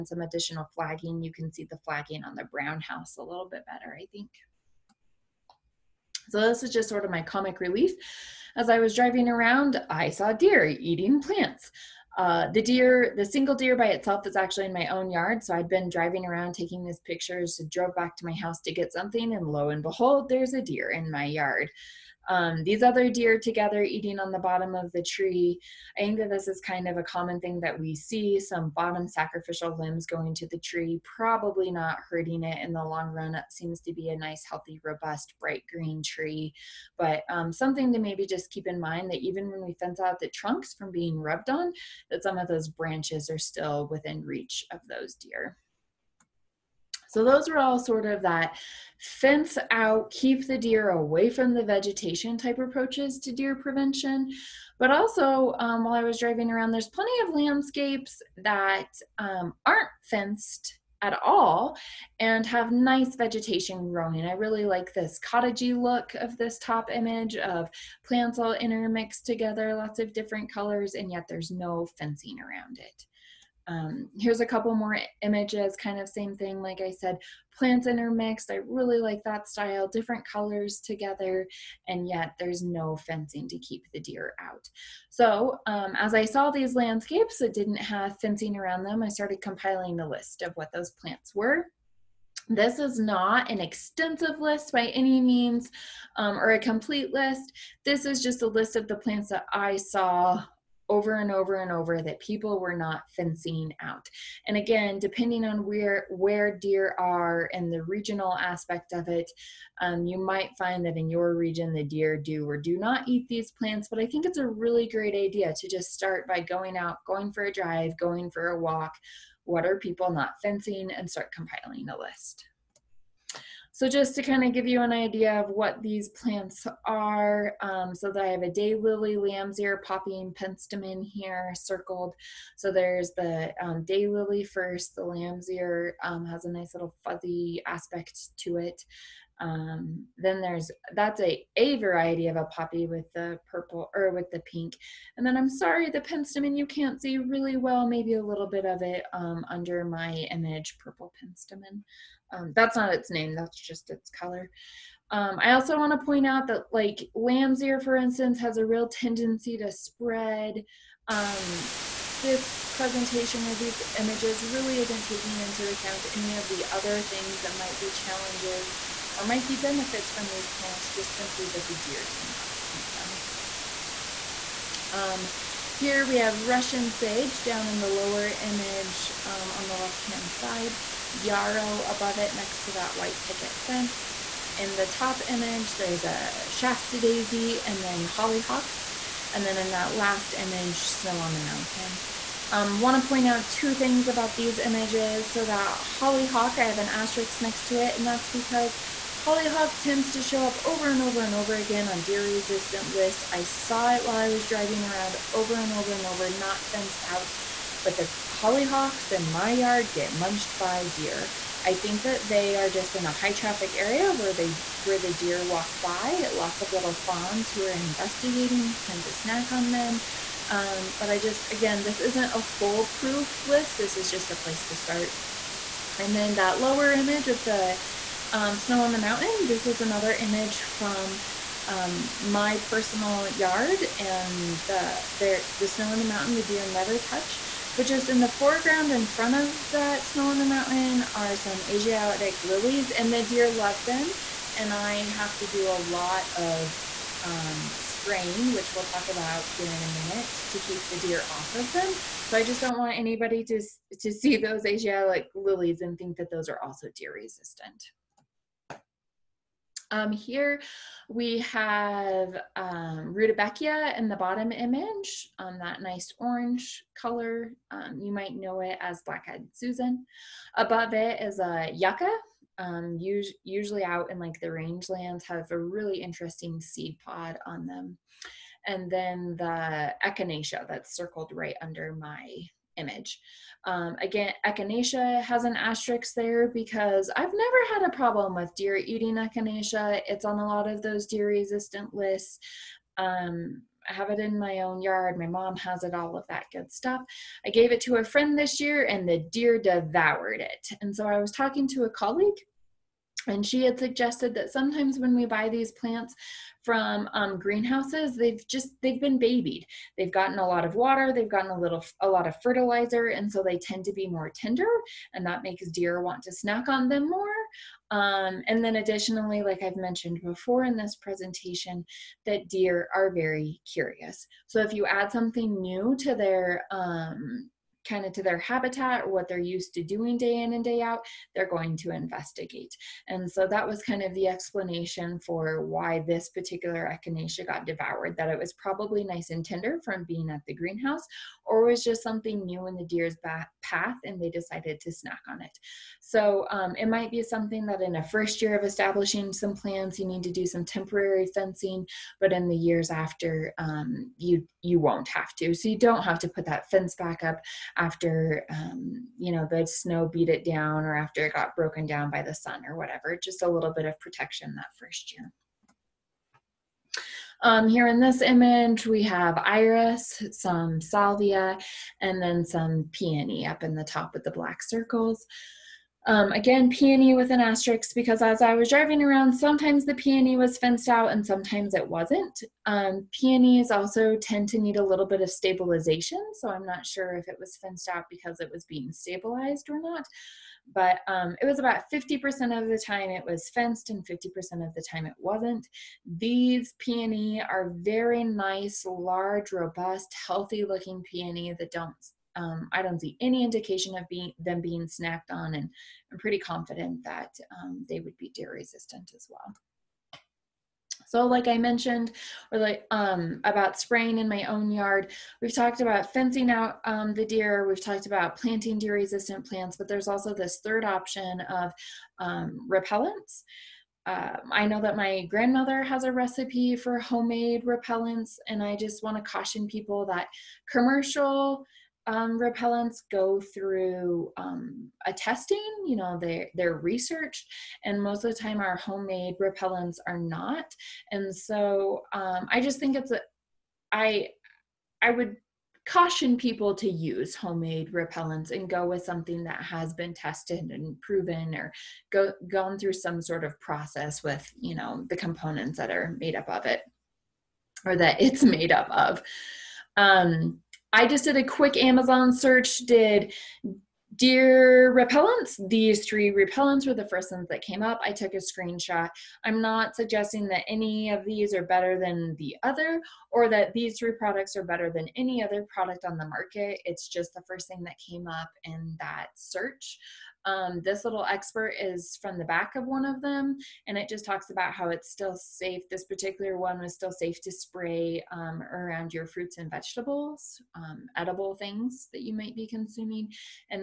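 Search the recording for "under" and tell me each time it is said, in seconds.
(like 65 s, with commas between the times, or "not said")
149 s, 281 s.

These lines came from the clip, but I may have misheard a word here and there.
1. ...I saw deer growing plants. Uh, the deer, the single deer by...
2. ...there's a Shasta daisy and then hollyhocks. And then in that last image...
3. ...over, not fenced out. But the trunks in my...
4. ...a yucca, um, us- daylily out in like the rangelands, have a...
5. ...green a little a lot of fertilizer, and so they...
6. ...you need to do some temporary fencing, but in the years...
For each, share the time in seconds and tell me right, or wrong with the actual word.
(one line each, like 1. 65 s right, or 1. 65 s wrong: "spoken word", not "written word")
1. 9 s wrong: "eating", not "growing"
2. 185 s right
3. 206 s wrong: "hollyhocks", not "trunks"
4. 271 s wrong: "usually", not "daylily"
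5. 311 s wrong: "gotten", not "green"
6. 349 s right.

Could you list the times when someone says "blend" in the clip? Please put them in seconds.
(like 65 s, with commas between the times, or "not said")
not said.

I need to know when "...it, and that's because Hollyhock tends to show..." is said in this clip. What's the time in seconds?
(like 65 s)
197 s.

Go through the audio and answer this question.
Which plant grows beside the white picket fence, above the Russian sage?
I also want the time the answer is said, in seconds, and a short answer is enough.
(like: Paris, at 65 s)
Yarrow, at 181 s.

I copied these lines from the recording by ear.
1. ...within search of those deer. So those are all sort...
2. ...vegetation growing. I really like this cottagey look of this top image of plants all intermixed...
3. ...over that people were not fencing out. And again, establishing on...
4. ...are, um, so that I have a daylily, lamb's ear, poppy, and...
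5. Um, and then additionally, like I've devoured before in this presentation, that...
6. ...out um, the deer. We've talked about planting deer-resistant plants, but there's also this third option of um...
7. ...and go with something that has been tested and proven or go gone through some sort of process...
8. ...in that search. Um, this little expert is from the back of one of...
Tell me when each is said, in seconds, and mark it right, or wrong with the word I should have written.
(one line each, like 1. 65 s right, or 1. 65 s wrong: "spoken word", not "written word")
1. 43 s wrong: "reach", not "search"
2. 63 s right
3. 101 s wrong: "depending", not "establishing"
4. 126 s right
5. 317 s wrong: "mentioned", not "devoured"
6. 416 s right
7. 448 s right
8. 478 s right.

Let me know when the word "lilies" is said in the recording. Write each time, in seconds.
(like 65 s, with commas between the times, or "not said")
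242 s, 255 s.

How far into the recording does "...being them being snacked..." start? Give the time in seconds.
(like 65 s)
404 s.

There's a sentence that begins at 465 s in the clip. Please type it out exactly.
These three repellents were the first ones that came up.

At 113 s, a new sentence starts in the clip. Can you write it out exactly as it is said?
But I think it's a really great idea to just start by going out, going for a drive, going for a walk.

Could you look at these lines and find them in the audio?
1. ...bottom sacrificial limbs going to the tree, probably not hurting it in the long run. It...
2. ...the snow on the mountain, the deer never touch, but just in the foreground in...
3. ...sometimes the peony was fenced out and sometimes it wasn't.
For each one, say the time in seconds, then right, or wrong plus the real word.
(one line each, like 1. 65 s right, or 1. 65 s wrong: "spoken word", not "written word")
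1. 28 s right
2. 235 s right
3. 379 s right.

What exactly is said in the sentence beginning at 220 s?
Um, but I just again, this isn't a foolproof list.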